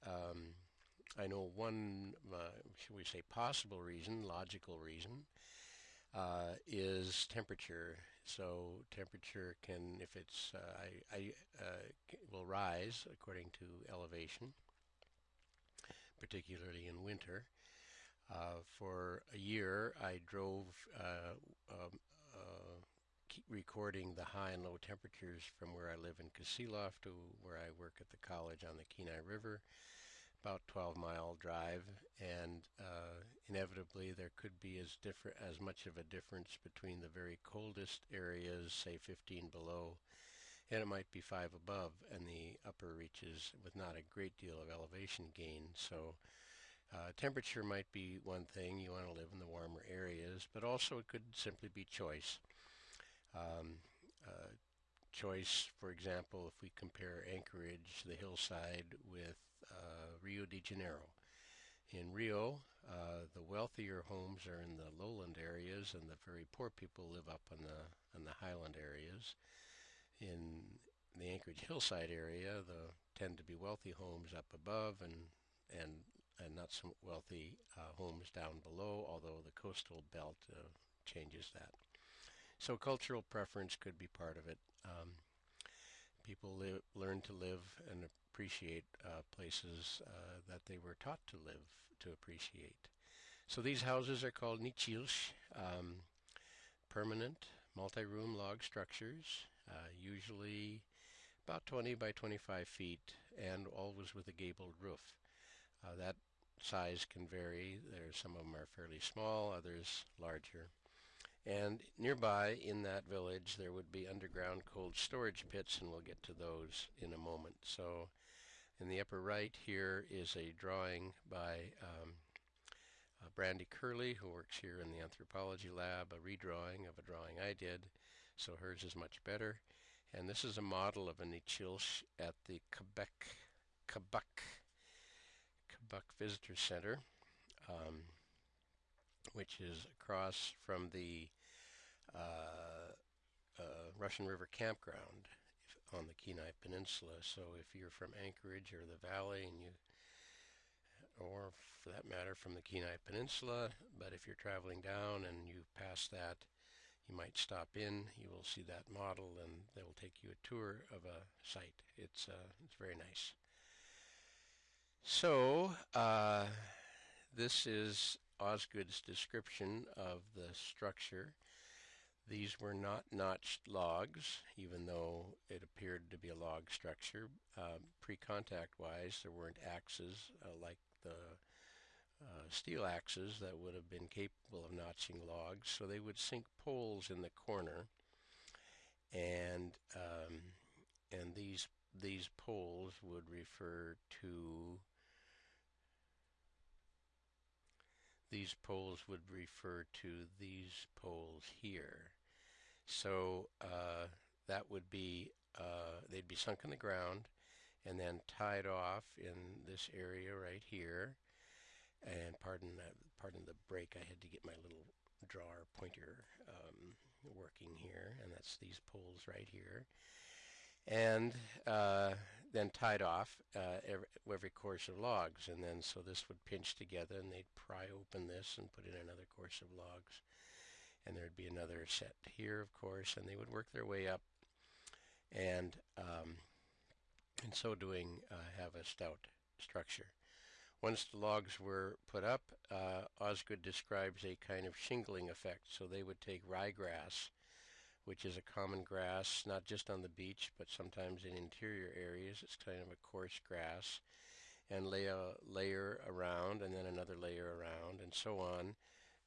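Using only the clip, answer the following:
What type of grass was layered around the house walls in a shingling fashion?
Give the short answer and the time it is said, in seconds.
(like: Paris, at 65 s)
Ryegrass, at 246 s.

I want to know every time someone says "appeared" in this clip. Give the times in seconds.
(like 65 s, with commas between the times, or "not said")
175 s.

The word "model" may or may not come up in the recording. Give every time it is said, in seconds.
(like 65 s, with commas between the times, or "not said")
130 s, 158 s.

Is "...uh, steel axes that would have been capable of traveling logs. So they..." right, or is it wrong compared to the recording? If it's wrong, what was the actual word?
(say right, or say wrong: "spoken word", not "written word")
wrong: "notching", not "traveling".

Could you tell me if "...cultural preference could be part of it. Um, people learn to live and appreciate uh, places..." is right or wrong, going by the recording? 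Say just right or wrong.
right.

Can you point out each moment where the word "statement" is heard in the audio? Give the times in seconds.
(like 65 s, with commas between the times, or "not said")
not said.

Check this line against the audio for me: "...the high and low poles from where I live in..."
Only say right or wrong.
wrong.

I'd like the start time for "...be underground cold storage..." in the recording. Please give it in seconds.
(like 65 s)
113 s.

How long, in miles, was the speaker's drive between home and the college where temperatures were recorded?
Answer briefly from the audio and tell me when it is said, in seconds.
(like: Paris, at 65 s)
12 miles, at 30 s.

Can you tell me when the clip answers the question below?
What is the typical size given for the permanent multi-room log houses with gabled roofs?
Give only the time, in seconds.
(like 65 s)
101 s.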